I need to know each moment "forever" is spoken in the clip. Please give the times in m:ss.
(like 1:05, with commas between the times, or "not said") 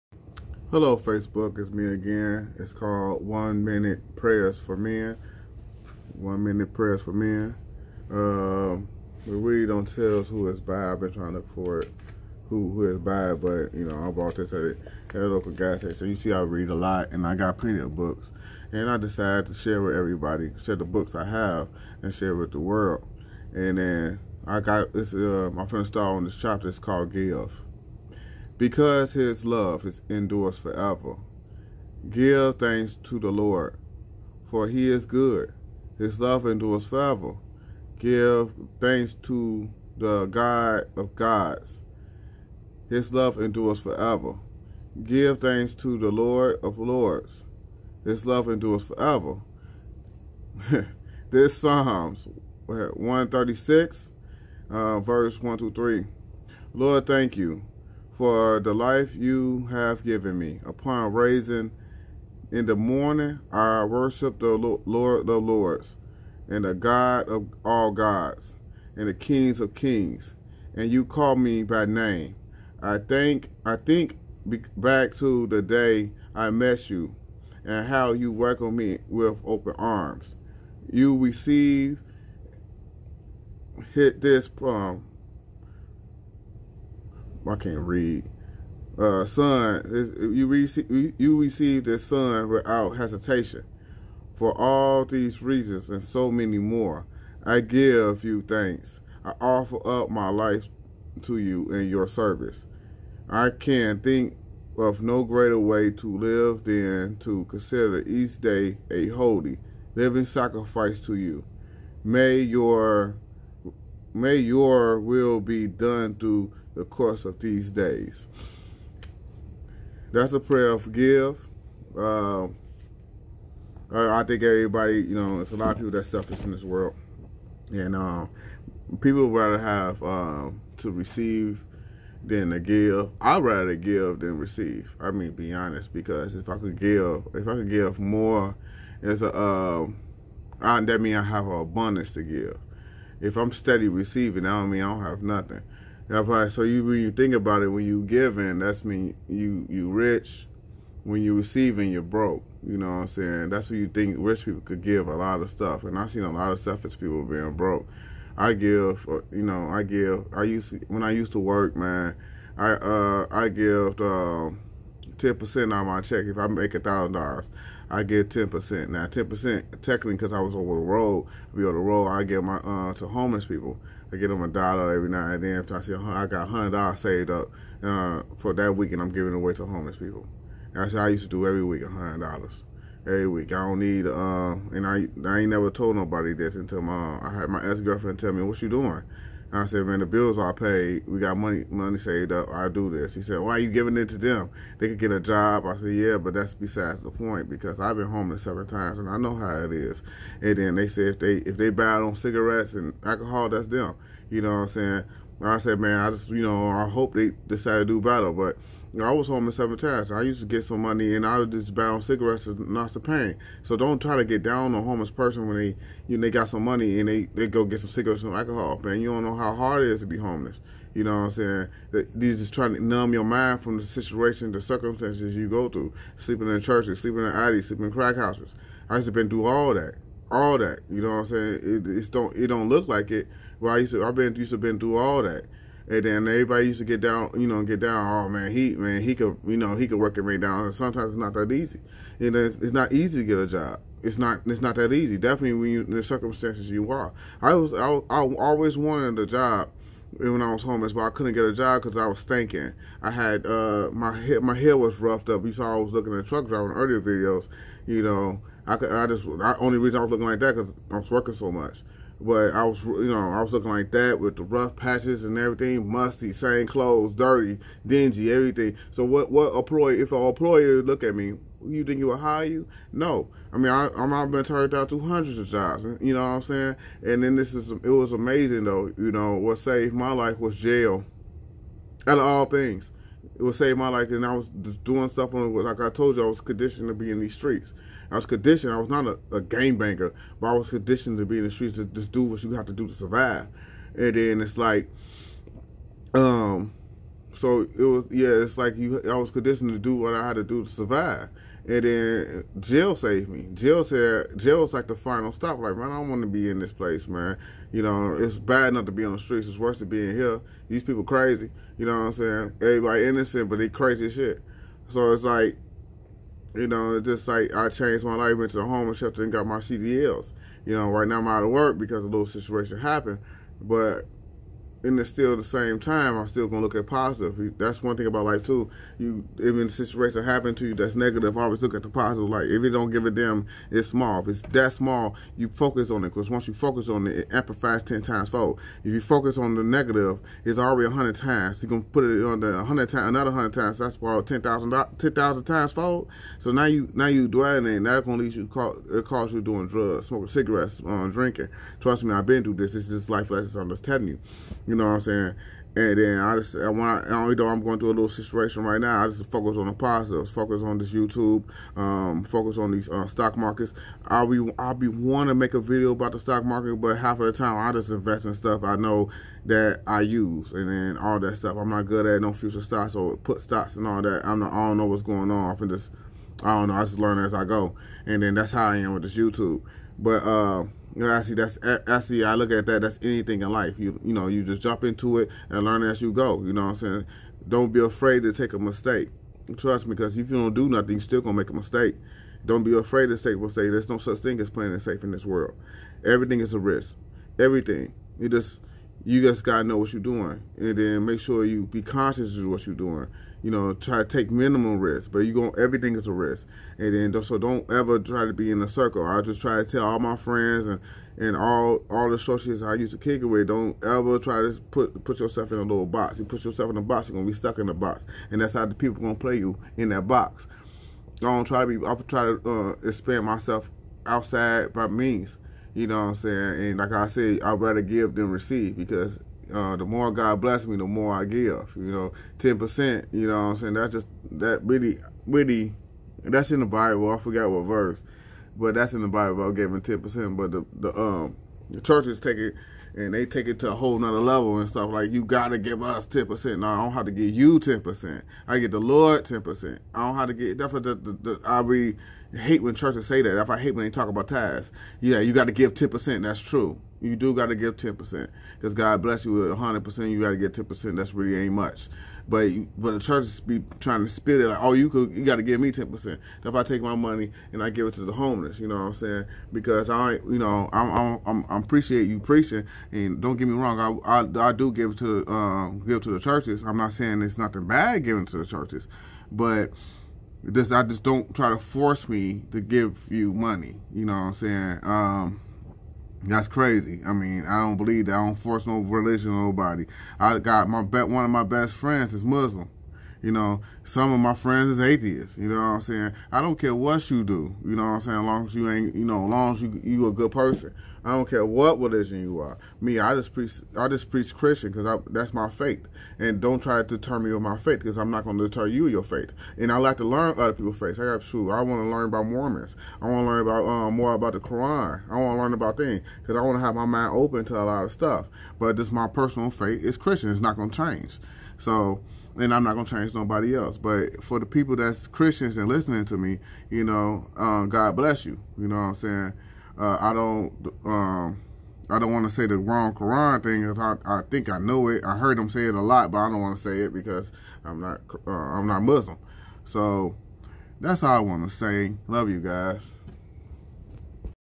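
0:30, 0:36, 0:43, 0:48.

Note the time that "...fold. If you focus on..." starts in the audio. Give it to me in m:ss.
5:38.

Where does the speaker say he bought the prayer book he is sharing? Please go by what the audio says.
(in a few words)
a local gas station.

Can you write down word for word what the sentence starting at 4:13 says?
I had uh, my hair, my hair was roughed up.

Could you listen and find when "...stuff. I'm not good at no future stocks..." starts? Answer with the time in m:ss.
6:11.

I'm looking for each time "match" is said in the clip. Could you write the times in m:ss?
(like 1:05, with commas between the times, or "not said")
not said.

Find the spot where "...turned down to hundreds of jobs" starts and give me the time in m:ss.
4:34.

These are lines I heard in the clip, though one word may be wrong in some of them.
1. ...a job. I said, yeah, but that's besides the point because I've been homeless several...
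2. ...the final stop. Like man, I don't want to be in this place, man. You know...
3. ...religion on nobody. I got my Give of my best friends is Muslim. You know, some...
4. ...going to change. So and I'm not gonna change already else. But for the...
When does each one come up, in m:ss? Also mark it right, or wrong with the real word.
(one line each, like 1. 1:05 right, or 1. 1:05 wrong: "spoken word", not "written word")
1. 3:15 right
2. 5:04 right
3. 8:08 wrong: "One", not "Give"
4. 8:40 wrong: "nobody", not "already".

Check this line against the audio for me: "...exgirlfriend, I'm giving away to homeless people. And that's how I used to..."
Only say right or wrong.
wrong.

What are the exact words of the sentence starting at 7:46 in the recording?
If I take my money and I give it to the homeless, you know what I'm saying?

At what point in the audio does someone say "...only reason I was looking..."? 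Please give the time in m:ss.
4:19.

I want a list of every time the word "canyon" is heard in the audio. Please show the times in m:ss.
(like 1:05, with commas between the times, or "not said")
not said.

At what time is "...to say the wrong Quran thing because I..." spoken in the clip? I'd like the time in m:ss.
8:52.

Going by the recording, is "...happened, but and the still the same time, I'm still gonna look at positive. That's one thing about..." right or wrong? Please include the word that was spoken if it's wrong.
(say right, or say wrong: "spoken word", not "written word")
right.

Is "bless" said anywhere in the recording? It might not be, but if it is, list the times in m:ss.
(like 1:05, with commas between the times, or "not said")
7:10, 7:39, 8:47.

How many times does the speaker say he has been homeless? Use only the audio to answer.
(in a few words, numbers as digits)
7.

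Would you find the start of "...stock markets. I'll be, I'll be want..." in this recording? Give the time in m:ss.
6:03.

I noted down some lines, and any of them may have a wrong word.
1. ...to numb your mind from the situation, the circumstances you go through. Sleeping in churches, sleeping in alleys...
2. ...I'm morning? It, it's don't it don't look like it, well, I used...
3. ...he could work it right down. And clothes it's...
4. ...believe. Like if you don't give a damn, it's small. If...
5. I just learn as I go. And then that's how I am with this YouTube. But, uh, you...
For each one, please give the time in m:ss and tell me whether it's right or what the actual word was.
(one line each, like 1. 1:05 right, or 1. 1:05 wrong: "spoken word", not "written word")
1. 3:42 right
2. 3:51 wrong: "saying", not "morning"
3. 3:59 wrong: "sometimes", not "clothes"
4. 5:31 wrong: "positive", not "believe"
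5. 6:16 right.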